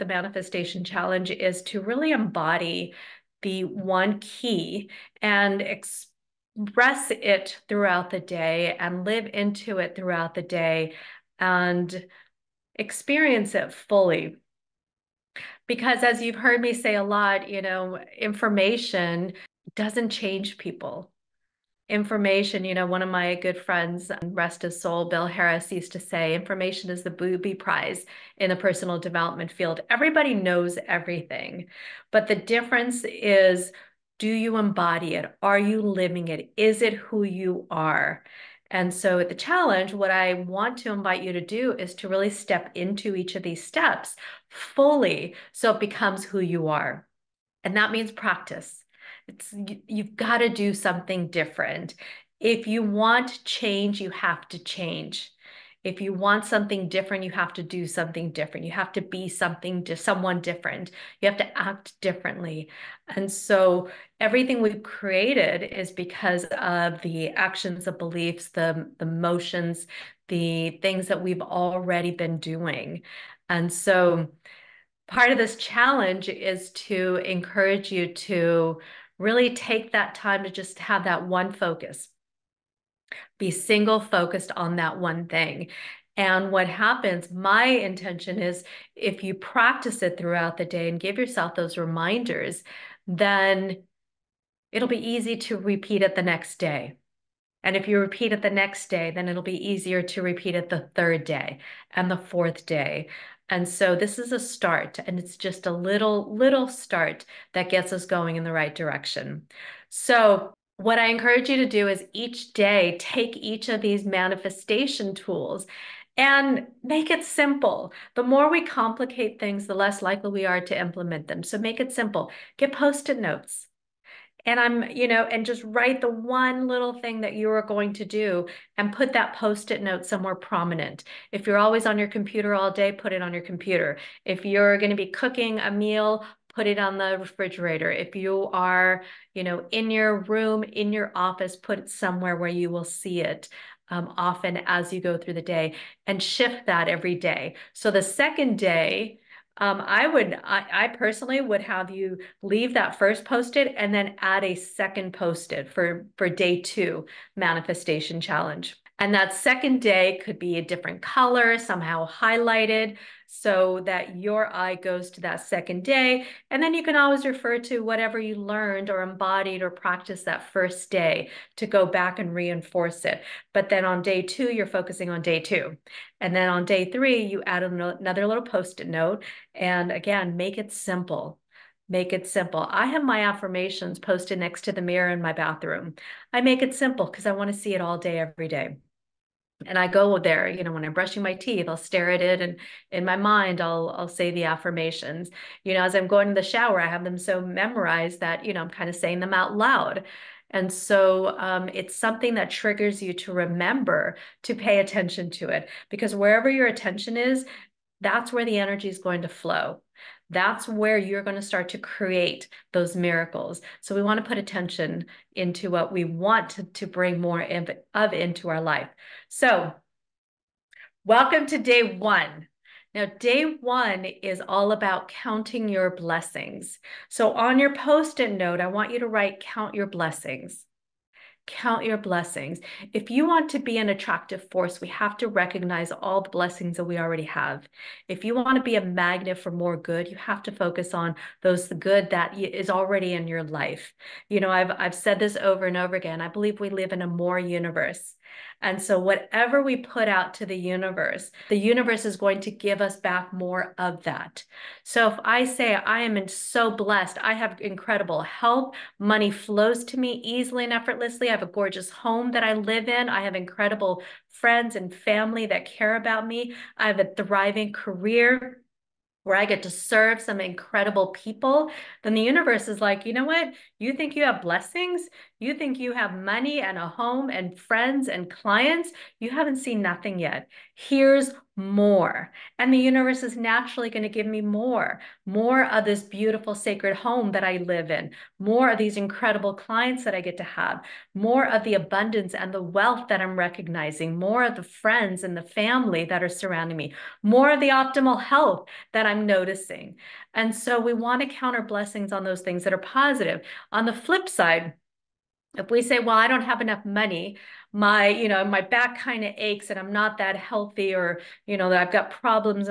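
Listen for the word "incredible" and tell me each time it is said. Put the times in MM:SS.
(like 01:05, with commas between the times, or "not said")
04:17, 04:23, 04:30, 04:48.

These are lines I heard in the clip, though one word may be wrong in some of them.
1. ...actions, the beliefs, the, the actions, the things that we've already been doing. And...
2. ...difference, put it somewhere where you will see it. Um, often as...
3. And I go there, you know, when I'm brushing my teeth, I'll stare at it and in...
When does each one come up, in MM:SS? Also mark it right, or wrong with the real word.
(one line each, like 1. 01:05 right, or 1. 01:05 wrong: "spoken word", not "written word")
1. 01:07 wrong: "motions", not "actions"
2. 02:21 wrong: "office", not "difference"
3. 03:09 right.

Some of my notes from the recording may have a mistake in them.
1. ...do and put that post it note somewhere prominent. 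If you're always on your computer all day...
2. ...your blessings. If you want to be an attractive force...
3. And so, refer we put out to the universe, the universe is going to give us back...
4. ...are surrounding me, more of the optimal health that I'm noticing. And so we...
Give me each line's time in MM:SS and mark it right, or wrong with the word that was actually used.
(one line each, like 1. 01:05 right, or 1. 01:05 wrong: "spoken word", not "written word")
1. 02:08 right
2. 03:51 right
3. 04:08 wrong: "whatever", not "refer"
4. 04:56 right.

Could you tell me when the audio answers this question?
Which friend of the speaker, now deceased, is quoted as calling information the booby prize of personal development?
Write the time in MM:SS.
00:25.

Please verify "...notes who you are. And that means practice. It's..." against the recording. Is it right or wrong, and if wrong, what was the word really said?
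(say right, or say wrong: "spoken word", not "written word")
wrong: "becomes", not "notes".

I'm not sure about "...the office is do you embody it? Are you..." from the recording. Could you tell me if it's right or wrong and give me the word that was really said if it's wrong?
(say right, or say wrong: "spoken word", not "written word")
wrong: "difference", not "office".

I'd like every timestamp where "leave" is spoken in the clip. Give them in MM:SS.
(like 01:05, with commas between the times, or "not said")
02:32.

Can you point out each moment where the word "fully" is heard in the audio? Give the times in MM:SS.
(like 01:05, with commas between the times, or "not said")
00:13, 00:44.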